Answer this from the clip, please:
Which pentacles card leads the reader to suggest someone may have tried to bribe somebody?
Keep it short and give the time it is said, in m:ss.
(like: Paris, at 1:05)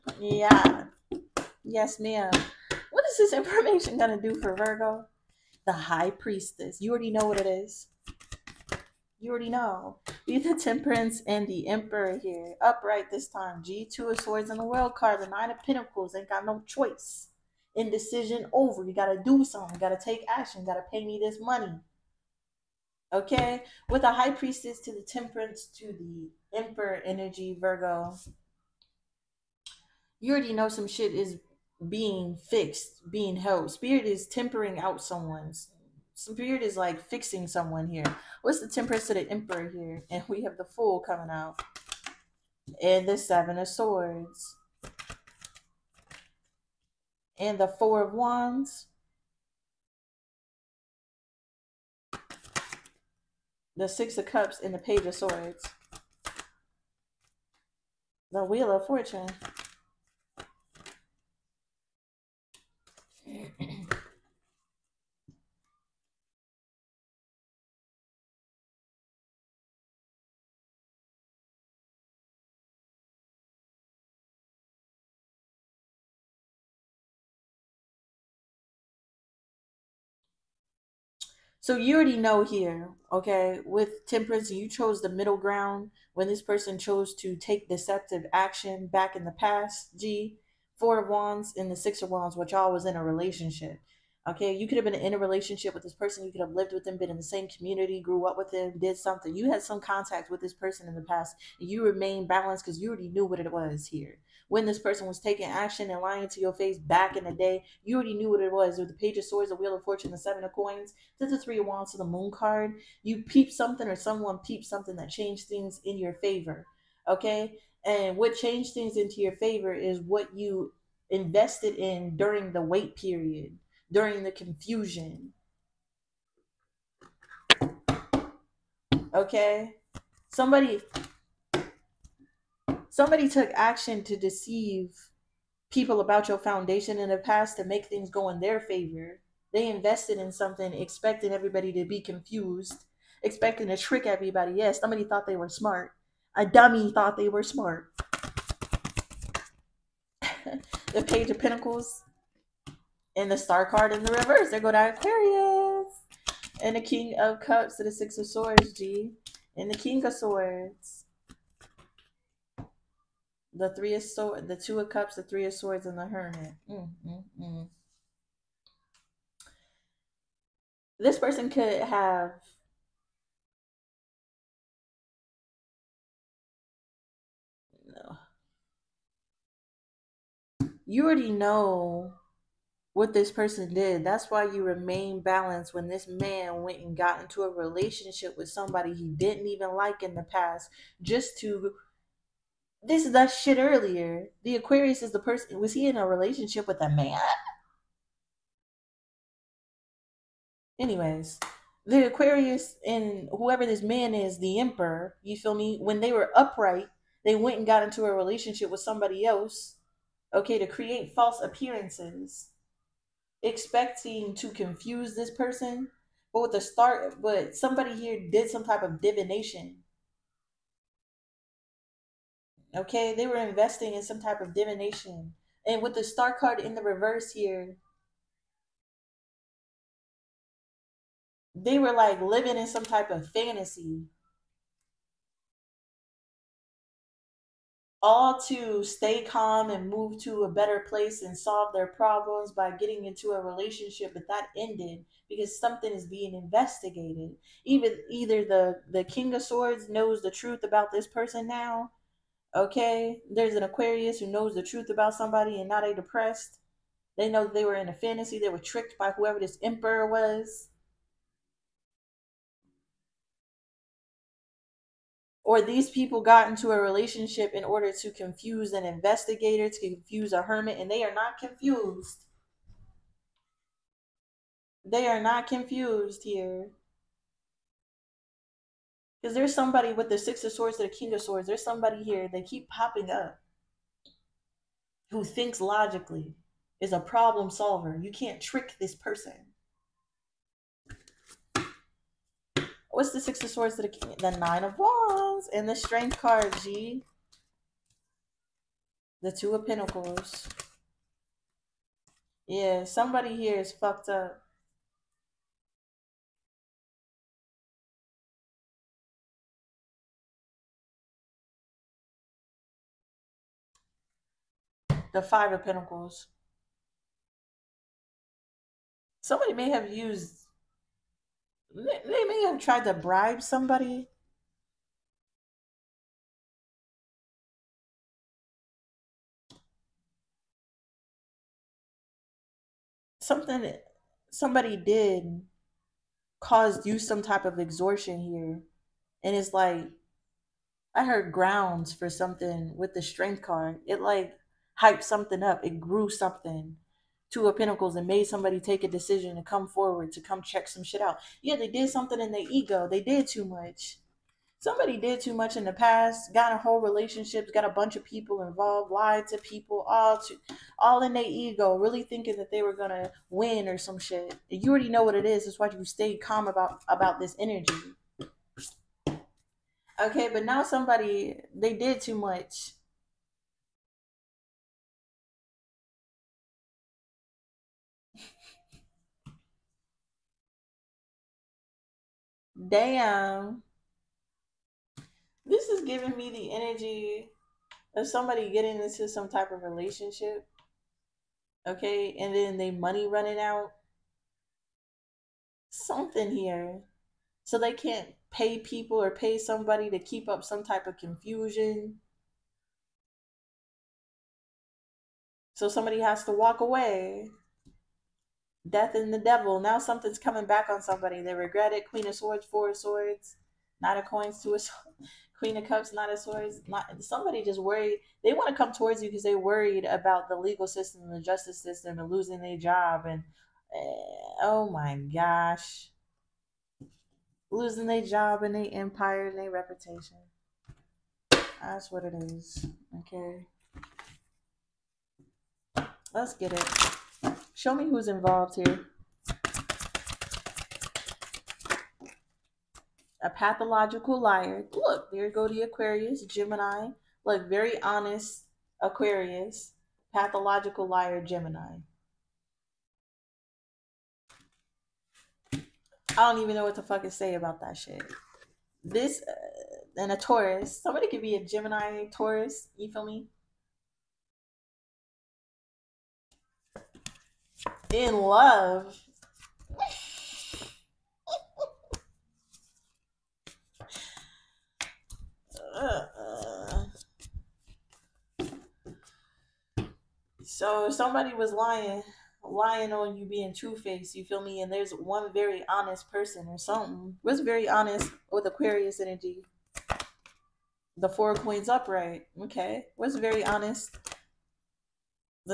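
Five of Pentacles, at 5:15.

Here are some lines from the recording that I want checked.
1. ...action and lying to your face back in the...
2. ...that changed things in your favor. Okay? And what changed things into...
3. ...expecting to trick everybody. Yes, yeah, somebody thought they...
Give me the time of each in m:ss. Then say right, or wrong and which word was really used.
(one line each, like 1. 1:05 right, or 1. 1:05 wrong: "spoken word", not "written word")
1. 1:45 right
2. 1:54 right
3. 2:23 right.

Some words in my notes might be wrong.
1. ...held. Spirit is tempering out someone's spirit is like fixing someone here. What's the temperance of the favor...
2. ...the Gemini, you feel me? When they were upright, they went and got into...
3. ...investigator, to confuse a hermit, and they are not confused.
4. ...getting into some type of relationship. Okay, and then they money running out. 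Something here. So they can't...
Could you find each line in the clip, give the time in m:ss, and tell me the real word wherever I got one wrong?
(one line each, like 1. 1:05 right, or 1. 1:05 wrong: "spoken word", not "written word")
1. 0:33 wrong: "emperor", not "favor"
2. 3:24 wrong: "Emperor", not "Gemini"
3. 4:28 right
4. 6:28 right.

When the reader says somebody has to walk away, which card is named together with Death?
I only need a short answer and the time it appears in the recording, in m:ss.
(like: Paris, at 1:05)
The Devil, at 6:49.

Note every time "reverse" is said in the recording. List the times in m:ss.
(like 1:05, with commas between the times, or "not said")
2:34, 3:46.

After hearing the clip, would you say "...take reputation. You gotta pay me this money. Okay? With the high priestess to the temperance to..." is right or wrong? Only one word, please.
wrong.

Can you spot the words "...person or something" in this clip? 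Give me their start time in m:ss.
8:06.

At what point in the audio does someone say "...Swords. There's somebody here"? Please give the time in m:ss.
4:41.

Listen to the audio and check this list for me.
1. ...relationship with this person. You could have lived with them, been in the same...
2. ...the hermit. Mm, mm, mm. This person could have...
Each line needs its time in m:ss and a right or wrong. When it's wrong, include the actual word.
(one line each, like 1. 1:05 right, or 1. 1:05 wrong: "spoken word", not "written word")
1. 1:35 right
2. 2:45 right.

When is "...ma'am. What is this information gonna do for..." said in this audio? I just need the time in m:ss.
0:01.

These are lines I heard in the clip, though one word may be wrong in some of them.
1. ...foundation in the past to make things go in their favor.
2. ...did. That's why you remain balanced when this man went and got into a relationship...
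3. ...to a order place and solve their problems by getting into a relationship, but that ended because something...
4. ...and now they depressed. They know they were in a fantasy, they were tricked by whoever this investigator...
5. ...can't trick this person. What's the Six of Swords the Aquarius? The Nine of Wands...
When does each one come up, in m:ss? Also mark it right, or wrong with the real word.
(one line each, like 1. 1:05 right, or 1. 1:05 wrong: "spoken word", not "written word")
1. 2:16 right
2. 3:03 right
3. 4:00 wrong: "better", not "order"
4. 4:15 wrong: "emperor", not "investigator"
5. 4:48 wrong: "King", not "Aquarius".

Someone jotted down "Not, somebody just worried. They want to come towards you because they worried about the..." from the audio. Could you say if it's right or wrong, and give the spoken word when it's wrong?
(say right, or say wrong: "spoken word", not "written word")
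right.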